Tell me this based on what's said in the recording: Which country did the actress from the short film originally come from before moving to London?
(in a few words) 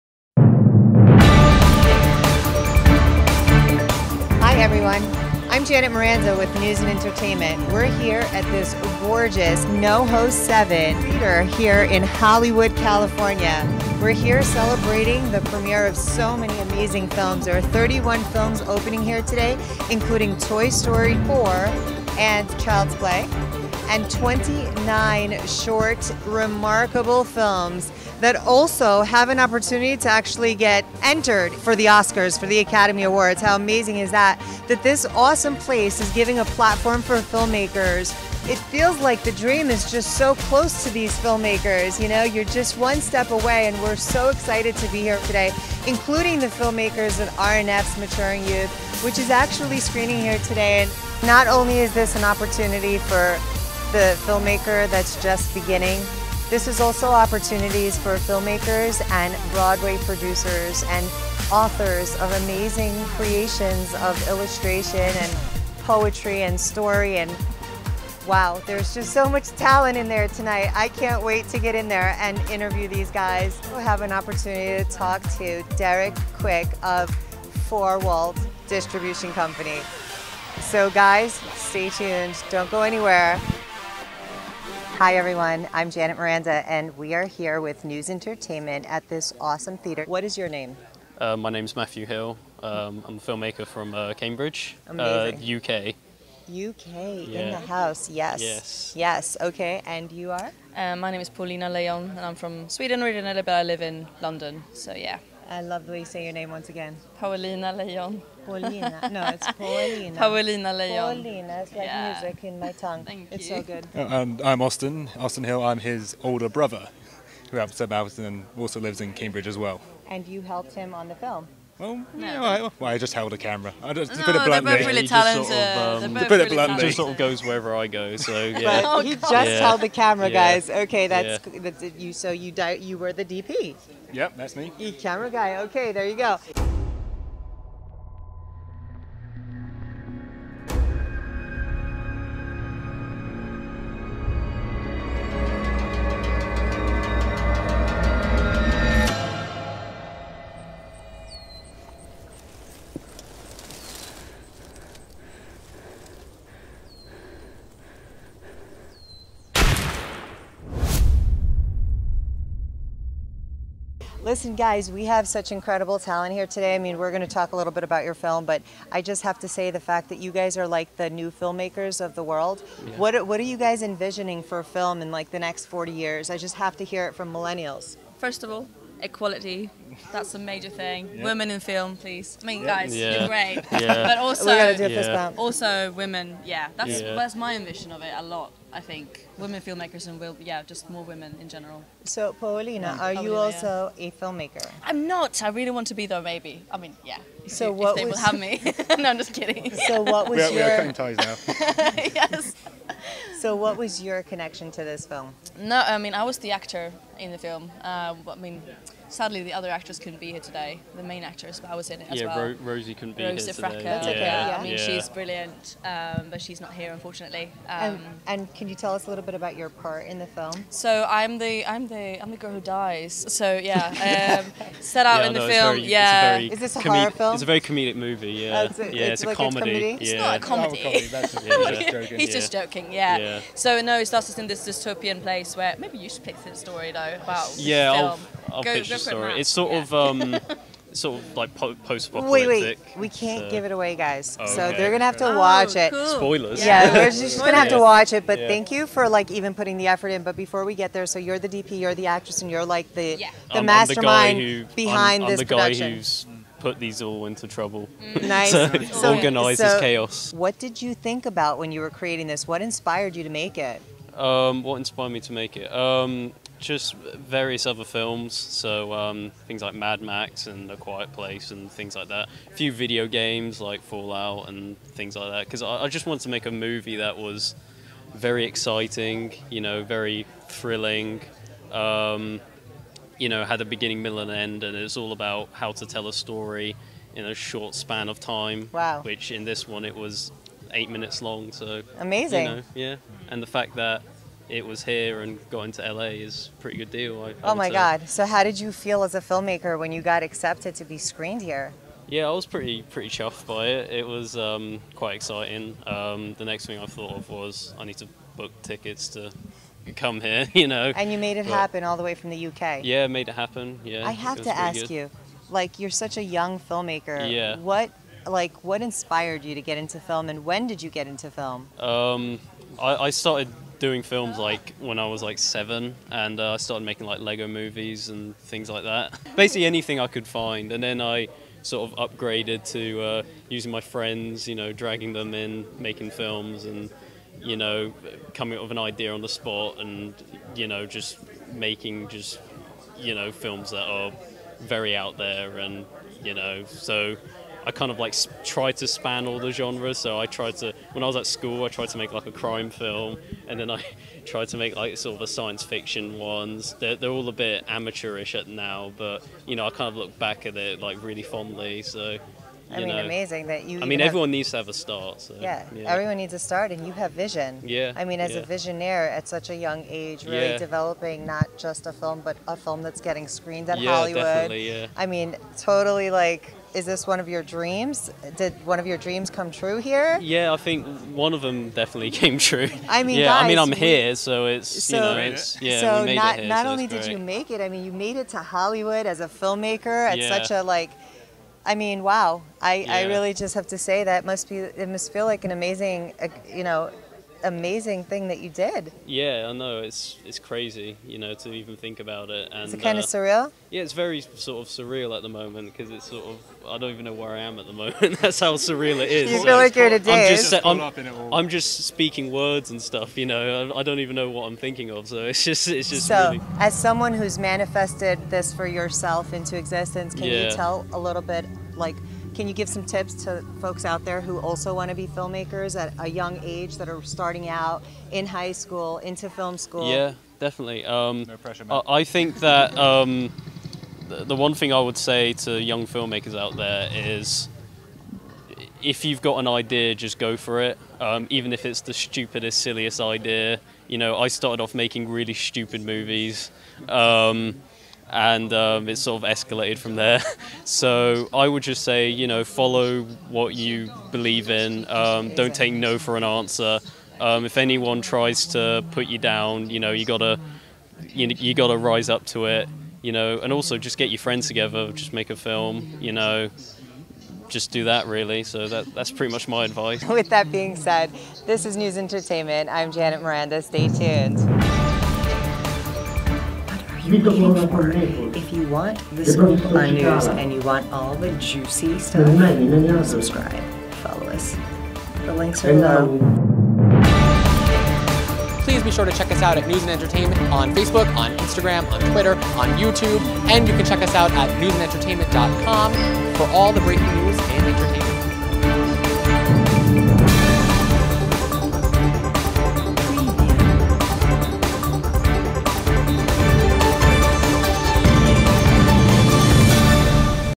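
Sweden.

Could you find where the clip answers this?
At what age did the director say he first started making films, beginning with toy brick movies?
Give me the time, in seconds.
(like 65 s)
325 s.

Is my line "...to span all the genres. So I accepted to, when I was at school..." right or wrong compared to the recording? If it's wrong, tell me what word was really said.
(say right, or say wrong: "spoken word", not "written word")
wrong: "tried", not "accepted".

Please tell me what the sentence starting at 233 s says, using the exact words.
So no, it starts us in this dystopian place where maybe you should pick the story though about yeah, film.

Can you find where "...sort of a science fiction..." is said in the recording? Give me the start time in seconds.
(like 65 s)
354 s.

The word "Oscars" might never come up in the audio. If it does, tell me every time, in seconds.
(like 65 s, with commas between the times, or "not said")
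31 s.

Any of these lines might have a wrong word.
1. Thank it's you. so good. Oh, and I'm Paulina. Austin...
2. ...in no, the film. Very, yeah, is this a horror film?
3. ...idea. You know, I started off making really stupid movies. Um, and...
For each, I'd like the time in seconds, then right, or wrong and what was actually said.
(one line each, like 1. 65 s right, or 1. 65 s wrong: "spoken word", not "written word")
1. 113 s wrong: "Austin", not "Paulina"
2. 225 s right
3. 443 s right.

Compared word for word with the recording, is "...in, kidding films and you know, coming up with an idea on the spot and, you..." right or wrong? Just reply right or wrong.
wrong.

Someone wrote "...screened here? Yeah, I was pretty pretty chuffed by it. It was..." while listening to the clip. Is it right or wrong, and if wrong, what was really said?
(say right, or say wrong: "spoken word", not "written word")
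right.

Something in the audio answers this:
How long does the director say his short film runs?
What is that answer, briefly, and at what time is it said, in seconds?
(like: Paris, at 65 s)
8 minutes, at 290 s.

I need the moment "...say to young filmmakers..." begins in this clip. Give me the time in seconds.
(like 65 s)
434 s.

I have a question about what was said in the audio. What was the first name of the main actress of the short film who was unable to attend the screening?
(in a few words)
Rosie.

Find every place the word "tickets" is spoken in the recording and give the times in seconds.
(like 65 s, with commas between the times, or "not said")
308 s.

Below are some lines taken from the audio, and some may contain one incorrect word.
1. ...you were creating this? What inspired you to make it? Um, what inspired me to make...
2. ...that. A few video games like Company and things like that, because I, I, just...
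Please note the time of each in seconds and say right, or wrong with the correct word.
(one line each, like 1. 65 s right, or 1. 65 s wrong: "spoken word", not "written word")
1. 261 s right
2. 272 s wrong: "Fallout", not "Company".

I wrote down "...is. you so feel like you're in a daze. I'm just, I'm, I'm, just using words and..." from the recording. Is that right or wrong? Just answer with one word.
wrong.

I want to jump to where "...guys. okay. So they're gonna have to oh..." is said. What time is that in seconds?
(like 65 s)
243 s.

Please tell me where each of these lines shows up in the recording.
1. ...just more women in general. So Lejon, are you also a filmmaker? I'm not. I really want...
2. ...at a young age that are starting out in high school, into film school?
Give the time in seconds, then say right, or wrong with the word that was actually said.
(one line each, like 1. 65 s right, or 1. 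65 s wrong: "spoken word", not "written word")
1. 190 s wrong: "Paulina", not "Lejon"
2. 425 s right.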